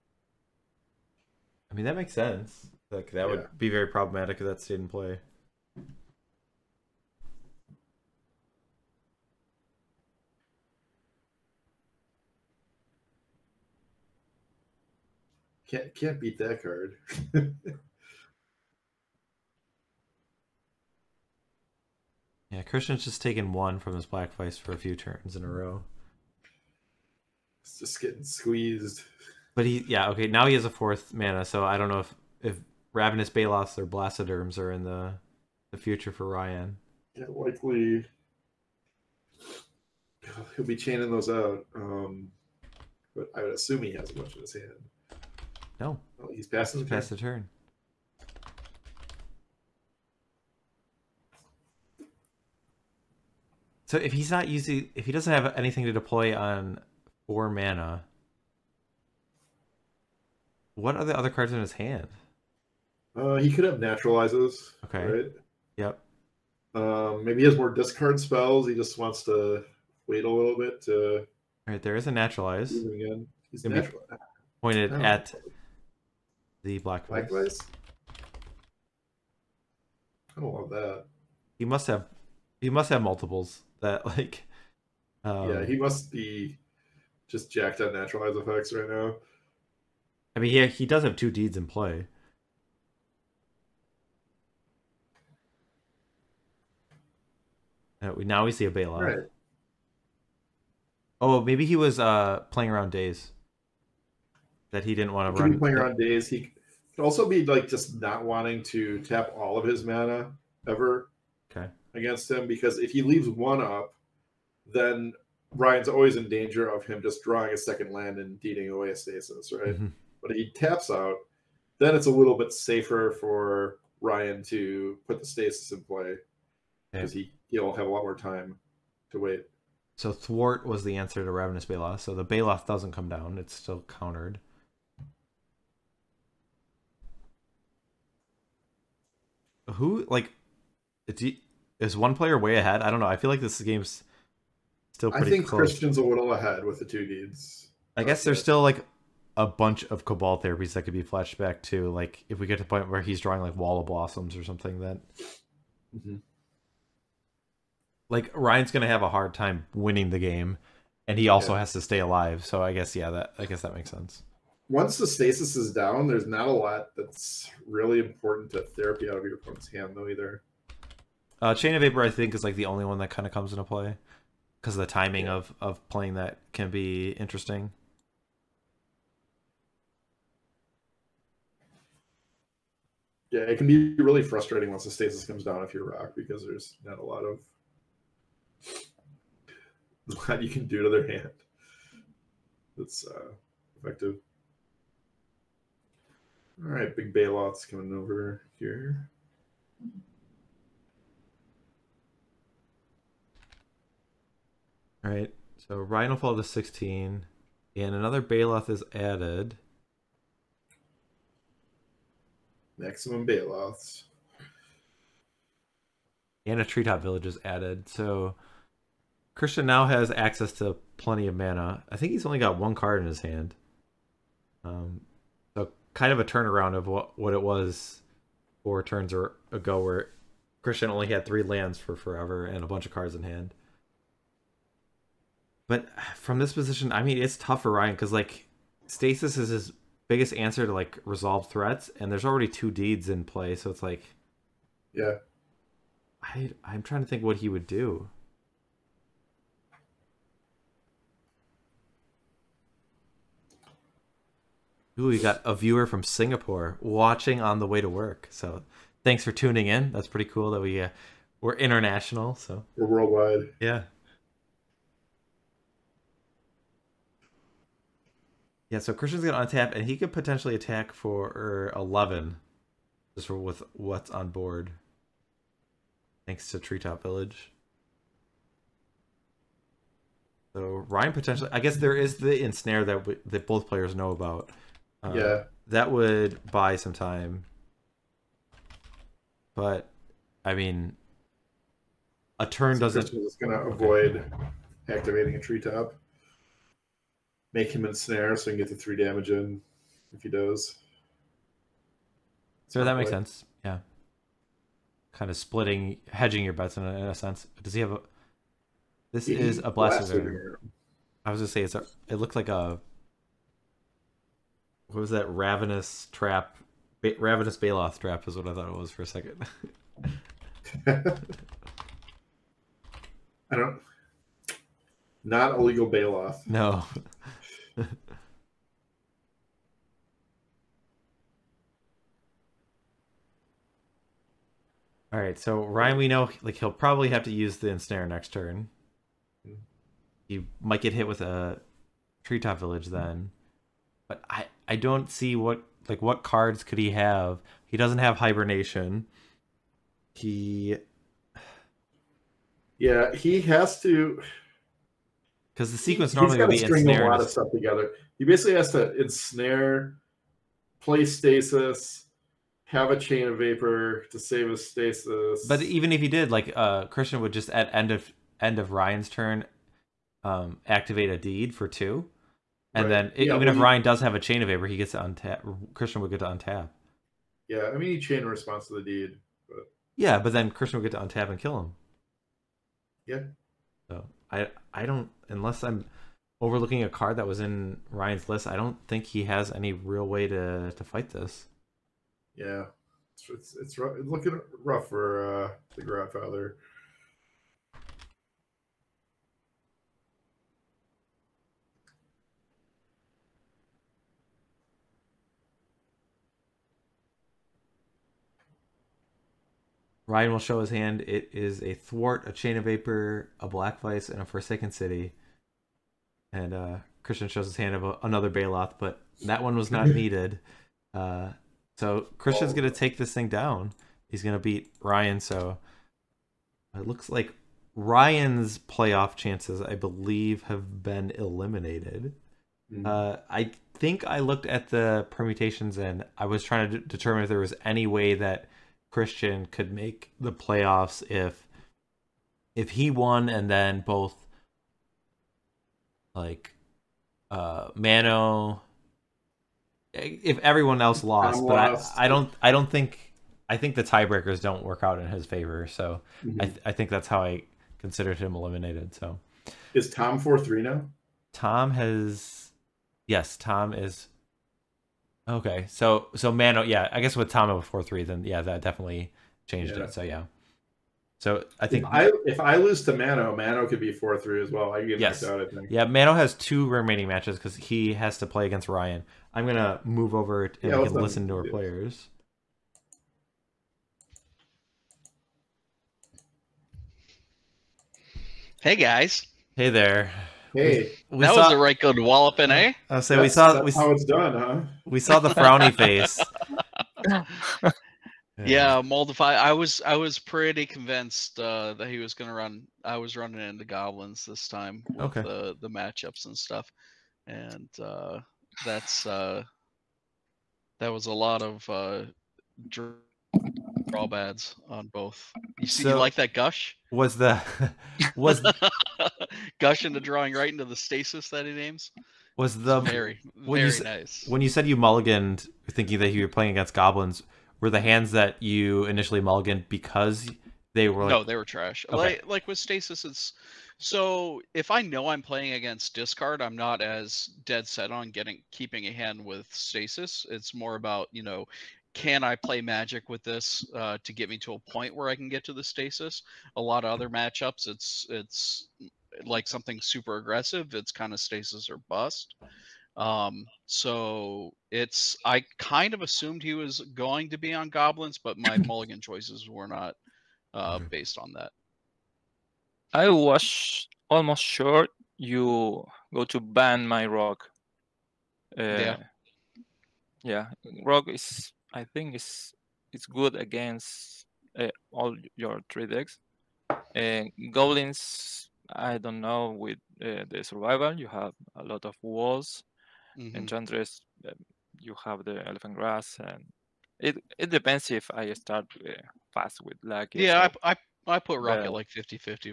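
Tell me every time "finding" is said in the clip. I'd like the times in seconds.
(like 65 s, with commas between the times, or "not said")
not said.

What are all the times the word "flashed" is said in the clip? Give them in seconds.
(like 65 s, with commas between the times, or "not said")
151 s.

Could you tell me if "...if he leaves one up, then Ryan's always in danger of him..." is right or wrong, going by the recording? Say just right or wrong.
right.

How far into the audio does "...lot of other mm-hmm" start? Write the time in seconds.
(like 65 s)
546 s.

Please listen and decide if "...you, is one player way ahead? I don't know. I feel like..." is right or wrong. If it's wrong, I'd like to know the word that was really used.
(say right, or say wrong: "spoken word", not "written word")
right.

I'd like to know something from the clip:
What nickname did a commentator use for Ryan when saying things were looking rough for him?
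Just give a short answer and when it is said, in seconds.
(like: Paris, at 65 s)
The Godfather, at 395 s.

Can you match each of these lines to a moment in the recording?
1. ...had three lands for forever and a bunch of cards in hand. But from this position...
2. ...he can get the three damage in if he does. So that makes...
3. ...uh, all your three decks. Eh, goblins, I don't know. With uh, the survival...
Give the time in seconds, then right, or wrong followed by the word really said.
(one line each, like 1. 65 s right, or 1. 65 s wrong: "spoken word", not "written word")
1. 231 s right
2. 298 s right
3. 574 s right.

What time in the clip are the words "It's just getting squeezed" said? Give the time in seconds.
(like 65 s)
27 s.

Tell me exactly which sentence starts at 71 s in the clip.
All right, there is a naturalize.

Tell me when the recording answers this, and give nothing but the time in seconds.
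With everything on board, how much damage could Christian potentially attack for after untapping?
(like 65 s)
271 s.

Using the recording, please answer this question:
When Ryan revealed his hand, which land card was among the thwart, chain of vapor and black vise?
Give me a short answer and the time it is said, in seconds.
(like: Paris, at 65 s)
Forsaken City, at 414 s.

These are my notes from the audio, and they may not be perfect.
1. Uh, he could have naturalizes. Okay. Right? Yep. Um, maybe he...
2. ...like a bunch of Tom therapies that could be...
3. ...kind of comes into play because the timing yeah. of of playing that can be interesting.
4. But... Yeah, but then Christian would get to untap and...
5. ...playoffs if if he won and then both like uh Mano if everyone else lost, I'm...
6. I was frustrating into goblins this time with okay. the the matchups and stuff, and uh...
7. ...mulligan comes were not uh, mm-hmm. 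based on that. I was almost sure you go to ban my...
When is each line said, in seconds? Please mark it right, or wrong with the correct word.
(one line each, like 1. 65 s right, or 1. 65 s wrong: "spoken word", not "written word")
1. 63 s right
2. 148 s wrong: "Cabal", not "Tom"
3. 173 s right
4. 379 s right
5. 440 s right
6. 502 s wrong: "running", not "frustrating"
7. 558 s wrong: "choices", not "comes".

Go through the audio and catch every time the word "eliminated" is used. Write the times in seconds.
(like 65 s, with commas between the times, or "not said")
431 s, 458 s.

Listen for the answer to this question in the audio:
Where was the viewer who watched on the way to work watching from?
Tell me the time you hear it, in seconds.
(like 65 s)
256 s.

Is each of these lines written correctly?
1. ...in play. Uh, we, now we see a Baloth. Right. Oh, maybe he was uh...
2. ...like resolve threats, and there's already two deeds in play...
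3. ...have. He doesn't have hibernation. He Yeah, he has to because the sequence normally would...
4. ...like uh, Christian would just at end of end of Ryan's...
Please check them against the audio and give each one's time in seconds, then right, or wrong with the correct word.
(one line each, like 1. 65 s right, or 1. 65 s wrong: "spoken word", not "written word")
1. 91 s right
2. 240 s right
3. 346 s right
4. 366 s right.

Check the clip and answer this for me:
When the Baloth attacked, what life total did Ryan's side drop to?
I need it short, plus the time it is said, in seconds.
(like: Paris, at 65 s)
16, at 206 s.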